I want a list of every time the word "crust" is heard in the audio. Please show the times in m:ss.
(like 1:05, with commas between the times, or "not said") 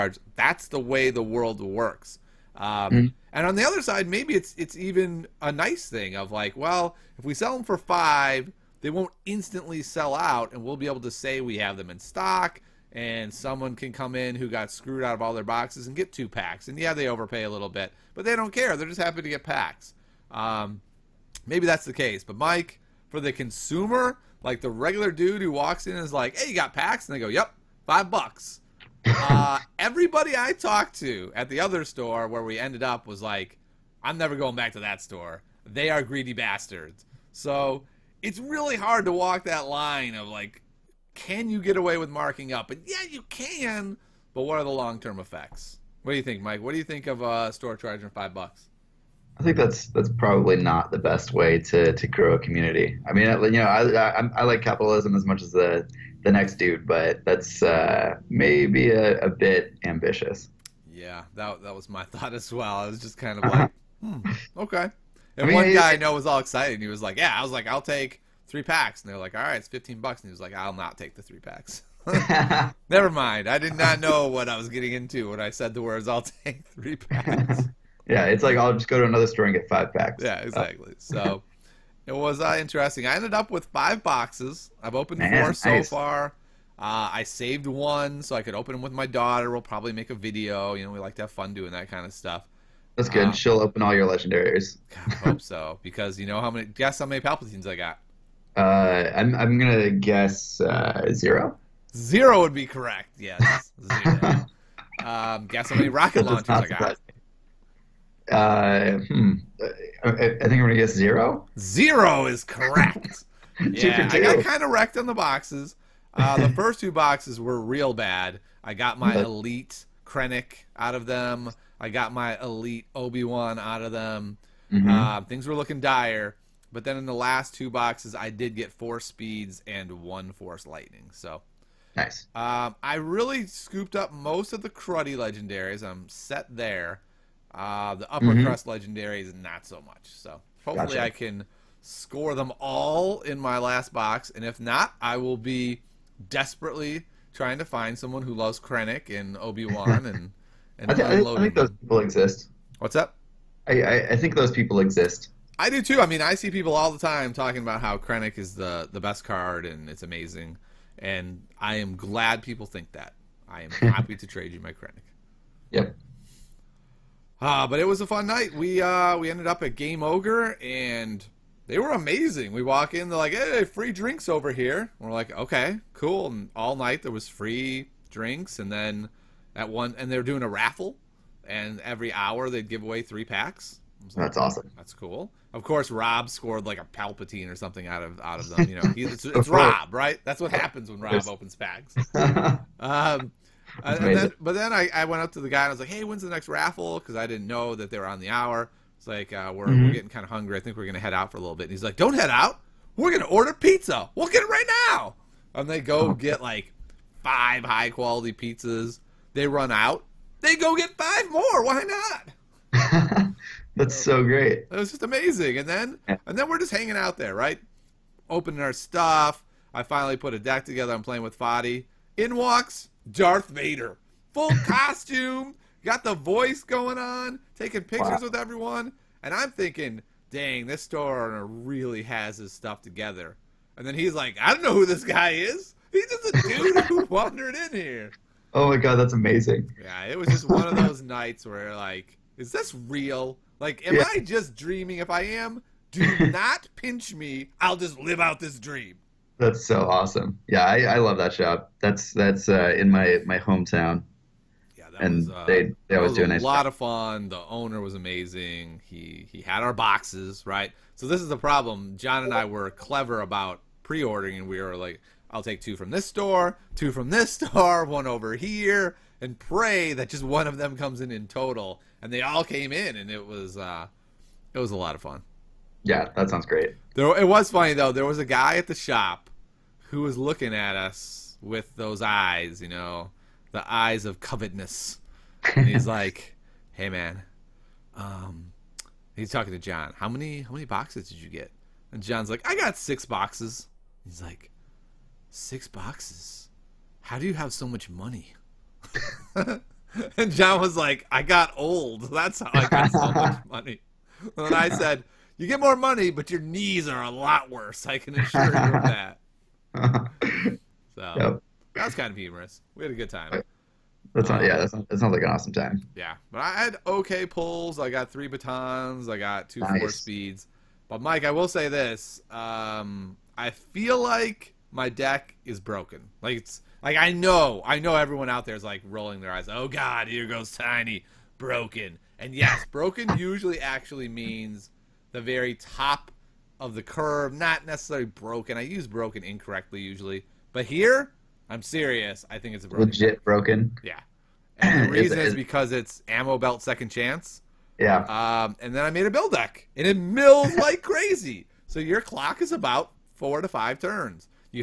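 2:18.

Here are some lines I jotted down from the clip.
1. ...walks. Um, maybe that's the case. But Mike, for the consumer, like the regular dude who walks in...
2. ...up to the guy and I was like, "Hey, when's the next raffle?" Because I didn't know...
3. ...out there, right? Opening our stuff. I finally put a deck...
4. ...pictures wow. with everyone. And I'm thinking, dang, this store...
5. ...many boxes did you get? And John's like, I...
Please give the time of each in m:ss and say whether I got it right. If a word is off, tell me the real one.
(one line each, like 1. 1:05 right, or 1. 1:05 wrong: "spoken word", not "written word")
1. 0:19 wrong: "packs", not "walks"
2. 3:15 right
3. 3:36 right
4. 3:47 right
5. 4:50 right.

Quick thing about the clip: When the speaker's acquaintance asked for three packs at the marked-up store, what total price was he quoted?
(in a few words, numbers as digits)
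$15.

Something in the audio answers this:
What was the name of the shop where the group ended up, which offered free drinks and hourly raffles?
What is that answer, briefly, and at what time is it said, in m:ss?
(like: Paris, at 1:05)
Game Ogre, at 2:49.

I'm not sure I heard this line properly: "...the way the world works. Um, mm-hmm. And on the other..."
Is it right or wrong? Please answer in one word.
right.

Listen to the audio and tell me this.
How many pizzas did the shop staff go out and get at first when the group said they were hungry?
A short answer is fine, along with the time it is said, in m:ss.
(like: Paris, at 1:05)
5, at 3:27.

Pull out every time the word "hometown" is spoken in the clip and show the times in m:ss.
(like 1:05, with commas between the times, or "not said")
4:13.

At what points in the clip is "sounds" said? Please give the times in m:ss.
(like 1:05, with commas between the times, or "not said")
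4:36, 5:14.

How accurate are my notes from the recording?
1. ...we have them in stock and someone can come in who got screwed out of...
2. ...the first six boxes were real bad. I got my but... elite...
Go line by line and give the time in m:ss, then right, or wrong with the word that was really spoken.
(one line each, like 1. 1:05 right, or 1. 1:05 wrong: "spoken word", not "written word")
1. 0:11 right
2. 1:56 wrong: "two", not "six".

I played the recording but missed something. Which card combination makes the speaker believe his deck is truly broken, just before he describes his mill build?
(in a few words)
ammo belt second chance.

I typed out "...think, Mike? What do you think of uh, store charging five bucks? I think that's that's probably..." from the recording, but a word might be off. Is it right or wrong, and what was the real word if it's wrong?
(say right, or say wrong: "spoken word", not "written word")
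right.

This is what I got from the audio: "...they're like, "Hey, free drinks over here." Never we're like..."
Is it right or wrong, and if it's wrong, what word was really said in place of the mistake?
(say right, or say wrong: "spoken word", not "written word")
wrong: "And", not "Never".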